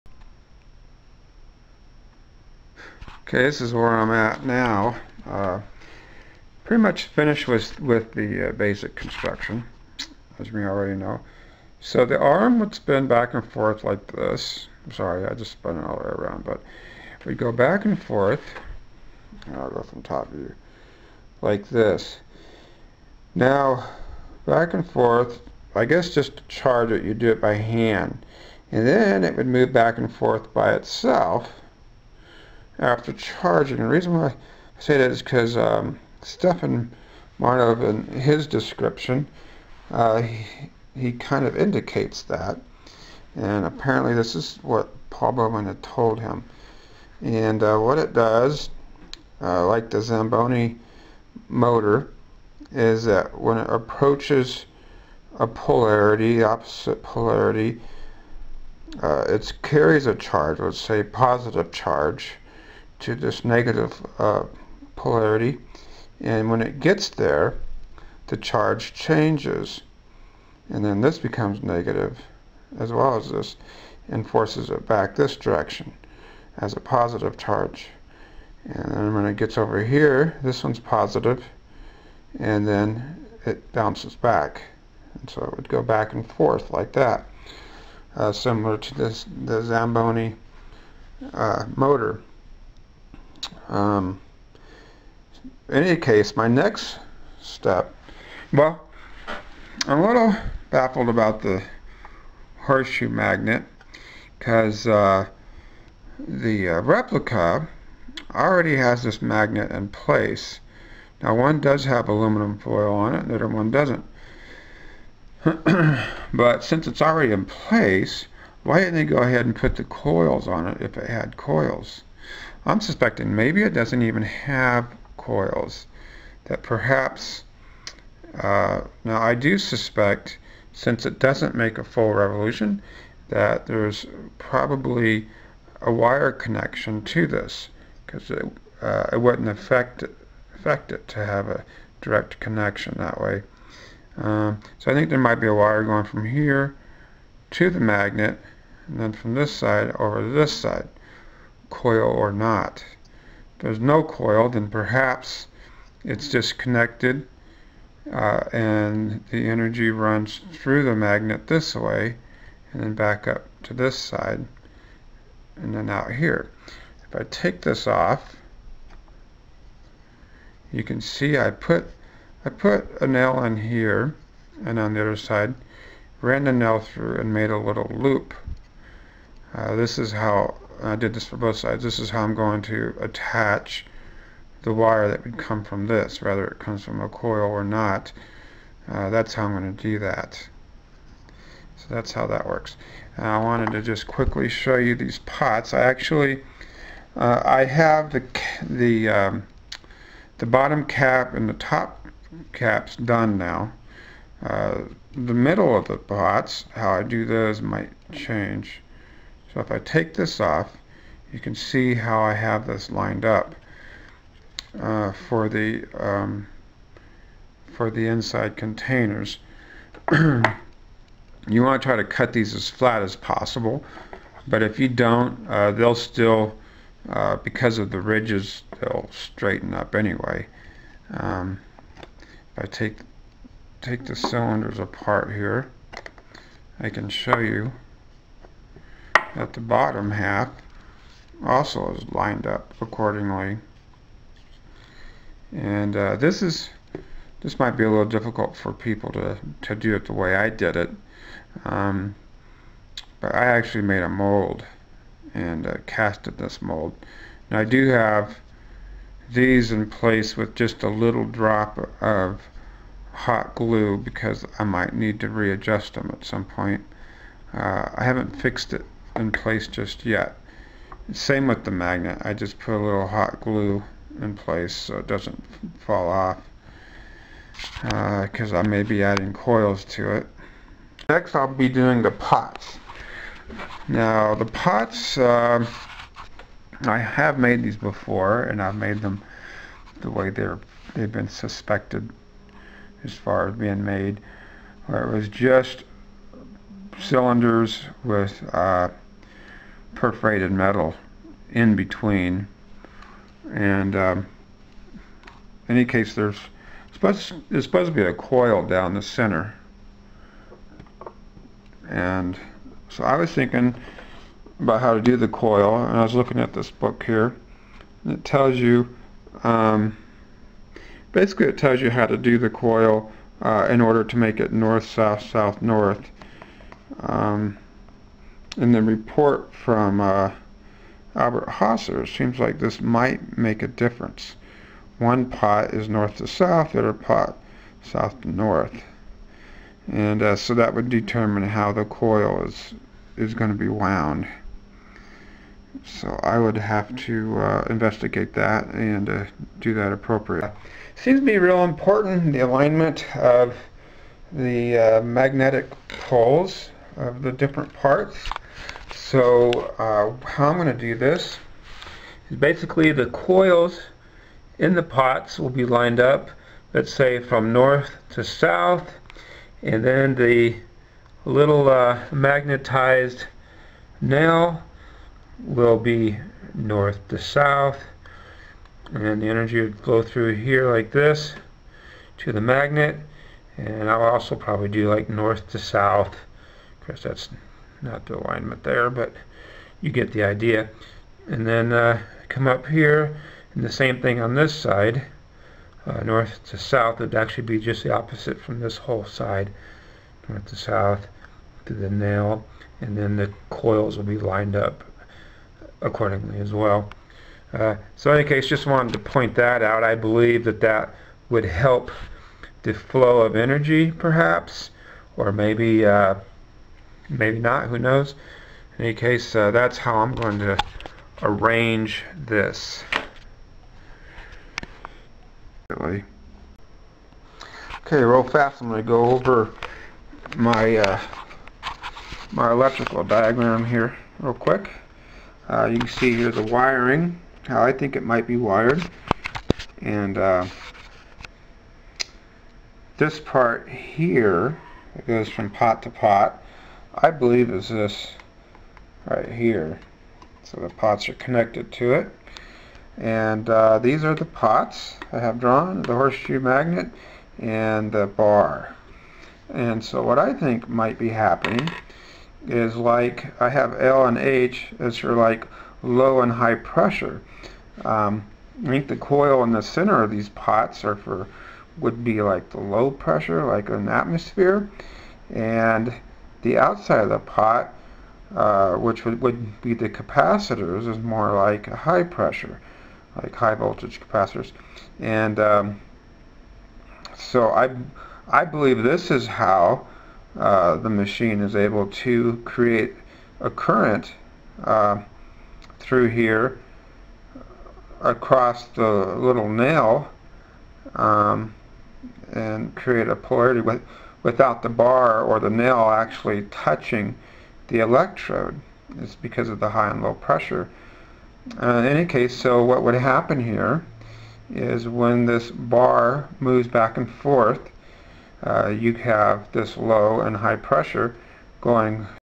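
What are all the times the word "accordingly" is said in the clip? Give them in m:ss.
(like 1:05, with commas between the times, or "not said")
4:02, 6:45.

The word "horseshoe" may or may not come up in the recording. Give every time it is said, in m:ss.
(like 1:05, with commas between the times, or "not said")
1:42, 7:35.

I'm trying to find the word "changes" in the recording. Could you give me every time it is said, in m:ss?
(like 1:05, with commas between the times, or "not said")
1:08, 3:28.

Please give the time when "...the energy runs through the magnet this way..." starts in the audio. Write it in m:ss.
2:39.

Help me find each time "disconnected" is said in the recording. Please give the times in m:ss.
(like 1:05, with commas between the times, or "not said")
2:36.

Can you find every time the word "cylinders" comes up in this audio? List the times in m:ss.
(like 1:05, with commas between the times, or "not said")
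3:54, 4:56.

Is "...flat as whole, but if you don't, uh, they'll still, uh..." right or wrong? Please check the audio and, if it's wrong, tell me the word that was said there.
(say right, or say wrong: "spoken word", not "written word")
wrong: "possible", not "whole".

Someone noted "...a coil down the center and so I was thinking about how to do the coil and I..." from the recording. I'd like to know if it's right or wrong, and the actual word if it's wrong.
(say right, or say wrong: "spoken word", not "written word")
right.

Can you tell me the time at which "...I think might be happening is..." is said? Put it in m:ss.
7:40.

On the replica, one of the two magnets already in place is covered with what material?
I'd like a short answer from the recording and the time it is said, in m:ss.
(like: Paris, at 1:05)
aluminum foil, at 1:52.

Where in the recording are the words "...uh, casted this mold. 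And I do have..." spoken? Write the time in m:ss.
4:15.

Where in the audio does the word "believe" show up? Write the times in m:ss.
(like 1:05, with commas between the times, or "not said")
6:49, 7:27, 8:08.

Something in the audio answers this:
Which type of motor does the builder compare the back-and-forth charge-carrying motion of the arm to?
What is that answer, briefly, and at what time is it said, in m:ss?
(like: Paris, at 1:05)
Zamboni motor, at 0:50.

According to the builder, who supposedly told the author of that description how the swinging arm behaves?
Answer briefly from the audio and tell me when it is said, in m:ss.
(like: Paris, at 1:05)
Paul Baumann, at 0:45.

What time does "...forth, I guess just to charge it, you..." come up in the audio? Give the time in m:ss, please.
0:24.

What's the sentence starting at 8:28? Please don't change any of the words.
It's because of the high and low pressure.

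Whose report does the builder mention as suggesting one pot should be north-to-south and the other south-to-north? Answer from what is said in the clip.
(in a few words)
Albert Haser.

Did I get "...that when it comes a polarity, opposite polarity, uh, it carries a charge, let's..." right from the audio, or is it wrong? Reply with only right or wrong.
wrong.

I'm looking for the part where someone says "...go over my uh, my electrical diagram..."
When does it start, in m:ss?
7:08.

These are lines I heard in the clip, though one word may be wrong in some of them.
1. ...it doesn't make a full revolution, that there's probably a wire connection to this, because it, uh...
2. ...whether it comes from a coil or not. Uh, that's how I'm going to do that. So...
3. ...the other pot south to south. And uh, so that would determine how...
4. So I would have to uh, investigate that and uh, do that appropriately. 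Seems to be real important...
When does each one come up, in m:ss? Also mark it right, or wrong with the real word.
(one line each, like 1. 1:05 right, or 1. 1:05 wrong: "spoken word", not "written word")
1. 2:11 right
2. 3:06 right
3. 5:36 wrong: "north", not "south"
4. 5:45 right.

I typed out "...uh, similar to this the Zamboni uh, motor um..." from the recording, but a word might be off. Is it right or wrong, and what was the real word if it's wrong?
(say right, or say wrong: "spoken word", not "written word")
right.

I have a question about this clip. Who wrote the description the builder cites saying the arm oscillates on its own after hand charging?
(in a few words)
Stefan Marinov.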